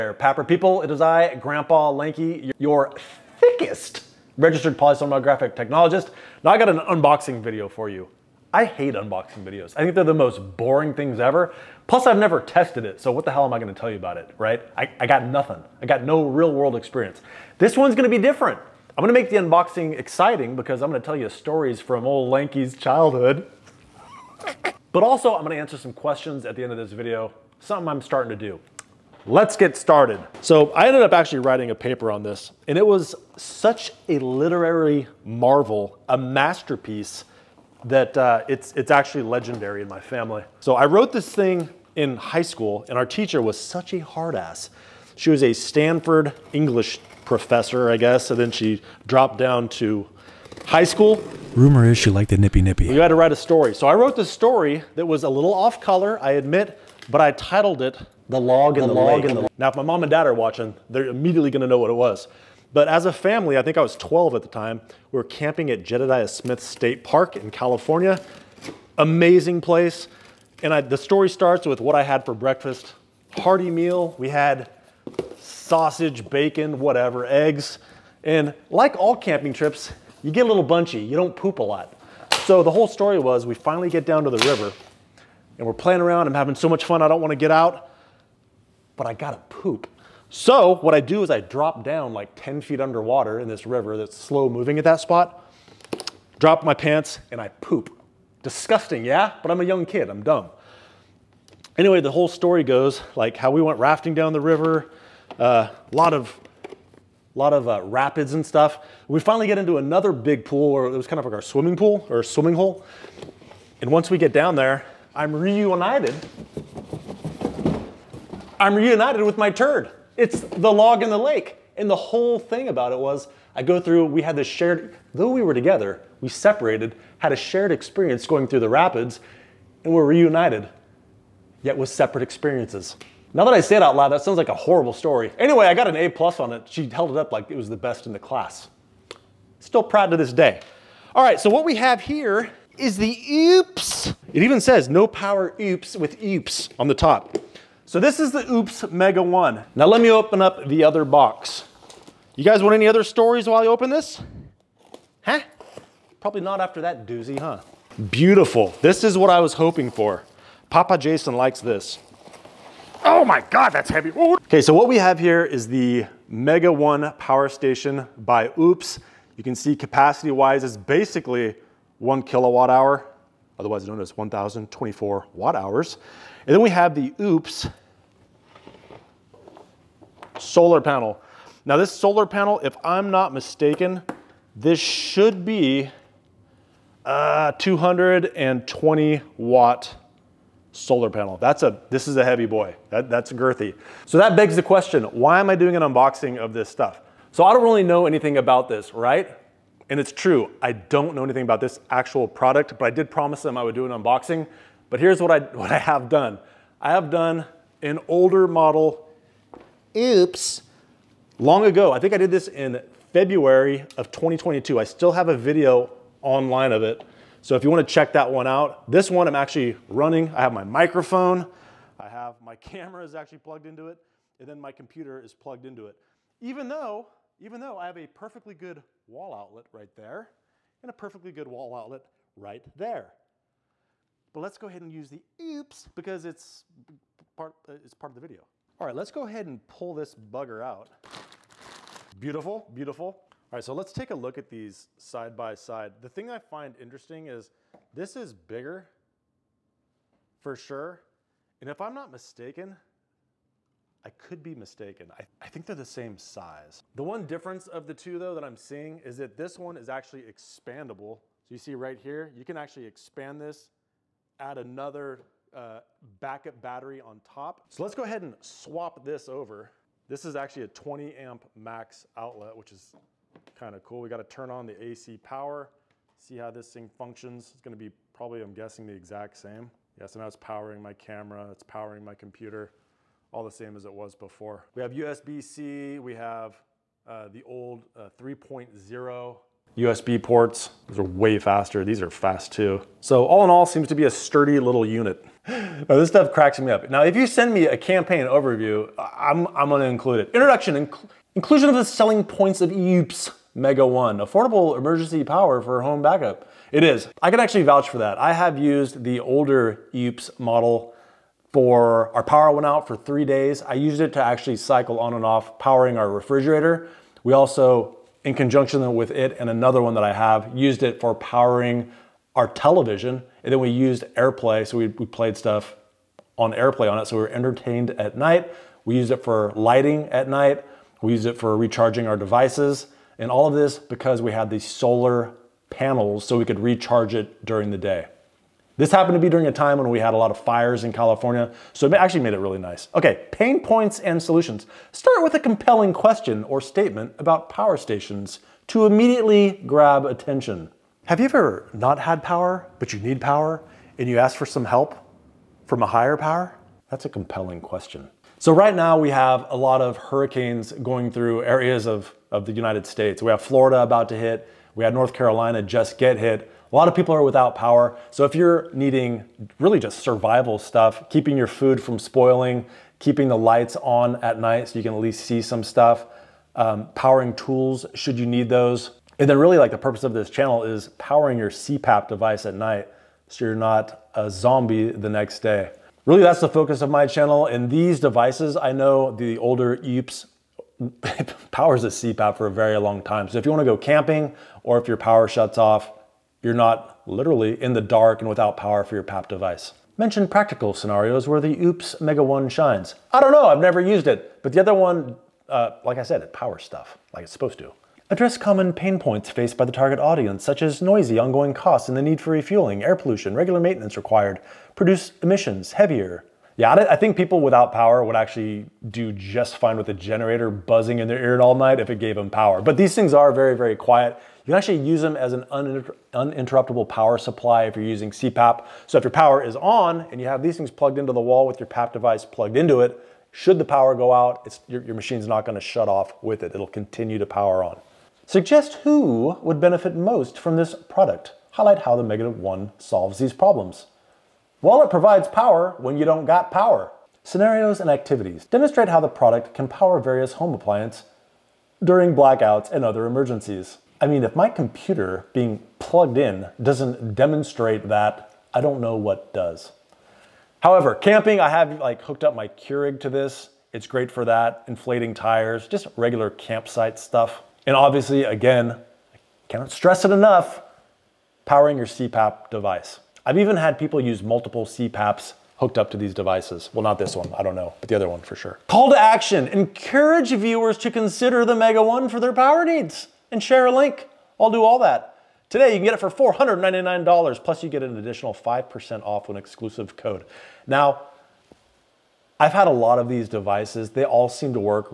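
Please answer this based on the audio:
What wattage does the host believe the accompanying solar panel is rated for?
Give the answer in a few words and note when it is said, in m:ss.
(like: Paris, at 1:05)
220 watts, at 3:07.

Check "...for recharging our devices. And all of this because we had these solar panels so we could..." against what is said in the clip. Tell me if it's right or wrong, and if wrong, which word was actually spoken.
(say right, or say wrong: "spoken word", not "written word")
right.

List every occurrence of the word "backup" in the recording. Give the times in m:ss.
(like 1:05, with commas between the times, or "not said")
4:26, 5:06.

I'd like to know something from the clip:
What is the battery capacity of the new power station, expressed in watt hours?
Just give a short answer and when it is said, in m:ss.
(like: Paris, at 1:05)
1,024 watt hours, at 2:54.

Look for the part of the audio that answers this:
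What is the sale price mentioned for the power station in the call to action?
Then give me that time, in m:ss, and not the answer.
8:06.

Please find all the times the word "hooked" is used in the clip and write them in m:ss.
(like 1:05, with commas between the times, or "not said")
7:42, 7:55.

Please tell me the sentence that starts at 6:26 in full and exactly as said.
Really that's the focus of my channel.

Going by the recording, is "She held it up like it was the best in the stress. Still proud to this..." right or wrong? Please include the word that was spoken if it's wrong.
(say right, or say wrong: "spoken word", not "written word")
wrong: "class", not "stress".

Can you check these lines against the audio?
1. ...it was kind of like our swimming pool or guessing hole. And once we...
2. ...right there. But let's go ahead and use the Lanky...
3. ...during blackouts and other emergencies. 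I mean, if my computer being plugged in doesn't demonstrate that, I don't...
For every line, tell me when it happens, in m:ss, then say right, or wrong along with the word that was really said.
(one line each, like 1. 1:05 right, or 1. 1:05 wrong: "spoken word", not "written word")
1. 1:50 wrong: "swimming", not "guessing"
2. 3:52 wrong: "OUPES", not "Lanky"
3. 7:31 right.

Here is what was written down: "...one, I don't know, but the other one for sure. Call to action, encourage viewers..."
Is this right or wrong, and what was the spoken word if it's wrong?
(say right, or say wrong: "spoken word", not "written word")
right.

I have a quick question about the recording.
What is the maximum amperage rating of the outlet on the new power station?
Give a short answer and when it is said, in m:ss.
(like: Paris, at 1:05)
20 amp, at 4:30.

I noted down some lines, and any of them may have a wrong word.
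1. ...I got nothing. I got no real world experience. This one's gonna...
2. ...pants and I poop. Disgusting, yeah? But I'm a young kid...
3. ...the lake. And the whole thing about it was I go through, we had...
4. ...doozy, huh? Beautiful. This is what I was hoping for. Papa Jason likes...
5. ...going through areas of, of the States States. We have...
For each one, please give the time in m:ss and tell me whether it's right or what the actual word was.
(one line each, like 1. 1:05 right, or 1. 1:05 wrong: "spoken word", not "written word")
1. 0:14 right
2. 1:36 right
3. 2:01 right
4. 2:37 right
5. 6:00 wrong: "United", not "States".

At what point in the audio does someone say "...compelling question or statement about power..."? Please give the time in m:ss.
5:45.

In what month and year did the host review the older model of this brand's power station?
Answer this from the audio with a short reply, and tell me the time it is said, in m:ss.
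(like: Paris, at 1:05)
February 2022, at 3:33.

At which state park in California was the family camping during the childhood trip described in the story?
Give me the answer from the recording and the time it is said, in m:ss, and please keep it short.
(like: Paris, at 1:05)
Jedediah Smith State Park, at 1:05.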